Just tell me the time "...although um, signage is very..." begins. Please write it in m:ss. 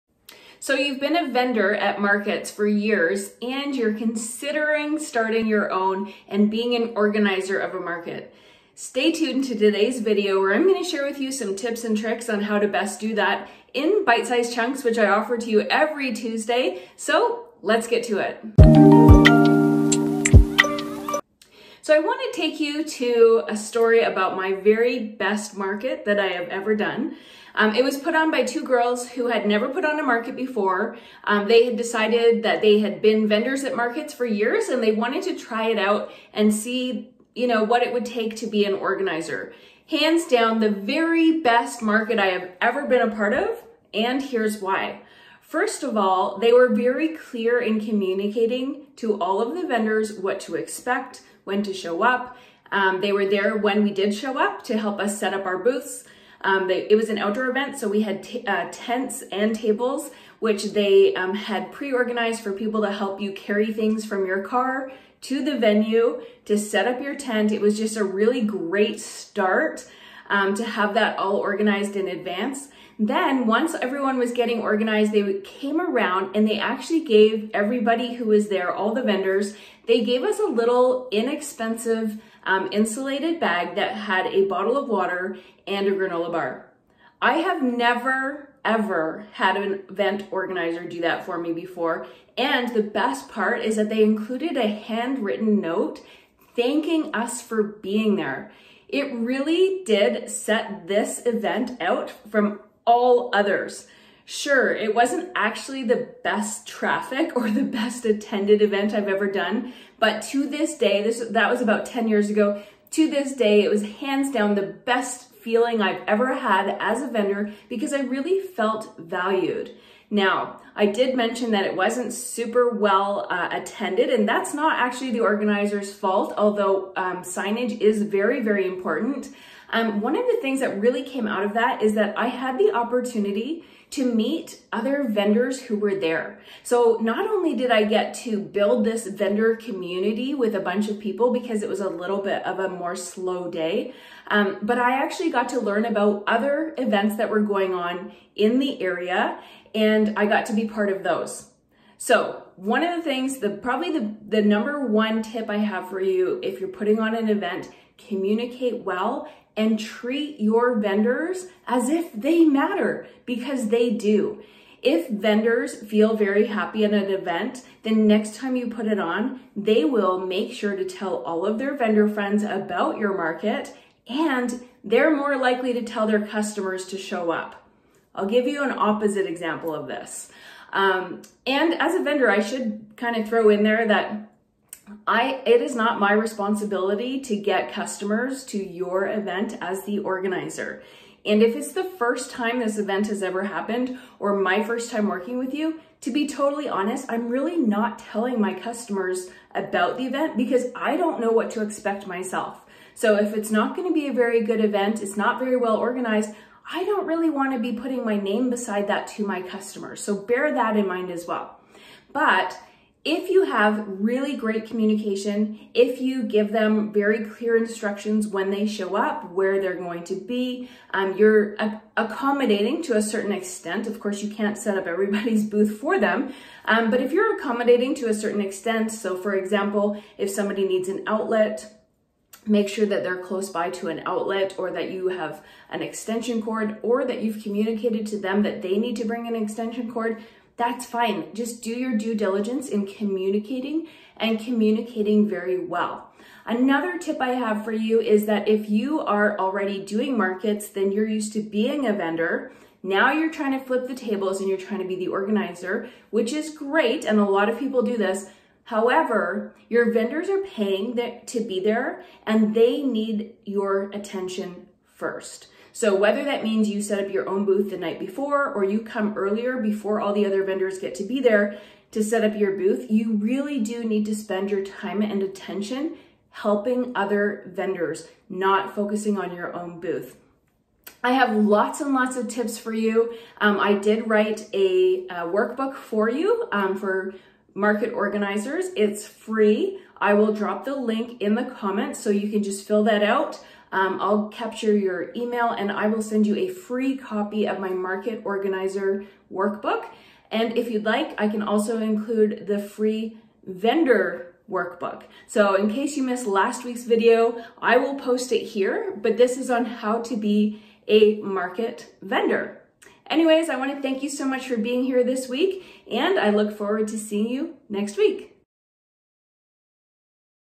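2:06.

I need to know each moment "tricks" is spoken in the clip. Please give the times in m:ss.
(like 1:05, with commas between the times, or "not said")
0:11.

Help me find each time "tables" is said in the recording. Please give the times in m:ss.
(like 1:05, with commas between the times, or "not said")
0:59, 4:13.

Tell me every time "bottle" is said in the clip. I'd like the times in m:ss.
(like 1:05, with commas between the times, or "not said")
1:24.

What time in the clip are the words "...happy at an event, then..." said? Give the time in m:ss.
2:46.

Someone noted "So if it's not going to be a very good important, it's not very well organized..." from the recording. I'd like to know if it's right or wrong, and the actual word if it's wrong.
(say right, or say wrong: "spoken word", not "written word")
wrong: "event", not "important".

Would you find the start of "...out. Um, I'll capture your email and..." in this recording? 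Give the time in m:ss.
4:53.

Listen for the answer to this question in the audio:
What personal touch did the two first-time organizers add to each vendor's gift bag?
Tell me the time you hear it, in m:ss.
1:34.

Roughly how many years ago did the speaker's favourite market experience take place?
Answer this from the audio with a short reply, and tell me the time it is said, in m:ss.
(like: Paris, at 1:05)
10, at 1:51.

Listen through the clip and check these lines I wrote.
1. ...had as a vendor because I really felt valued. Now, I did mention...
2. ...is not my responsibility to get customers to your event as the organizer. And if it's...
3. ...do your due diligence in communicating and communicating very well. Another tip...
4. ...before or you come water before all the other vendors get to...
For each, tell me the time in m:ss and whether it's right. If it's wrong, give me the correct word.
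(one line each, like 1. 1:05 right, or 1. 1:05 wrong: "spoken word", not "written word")
1. 1:56 right
2. 3:05 right
3. 4:01 right
4. 4:27 wrong: "earlier", not "water".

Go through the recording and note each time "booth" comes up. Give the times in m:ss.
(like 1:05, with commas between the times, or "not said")
0:55, 3:45, 4:27, 4:32, 4:39.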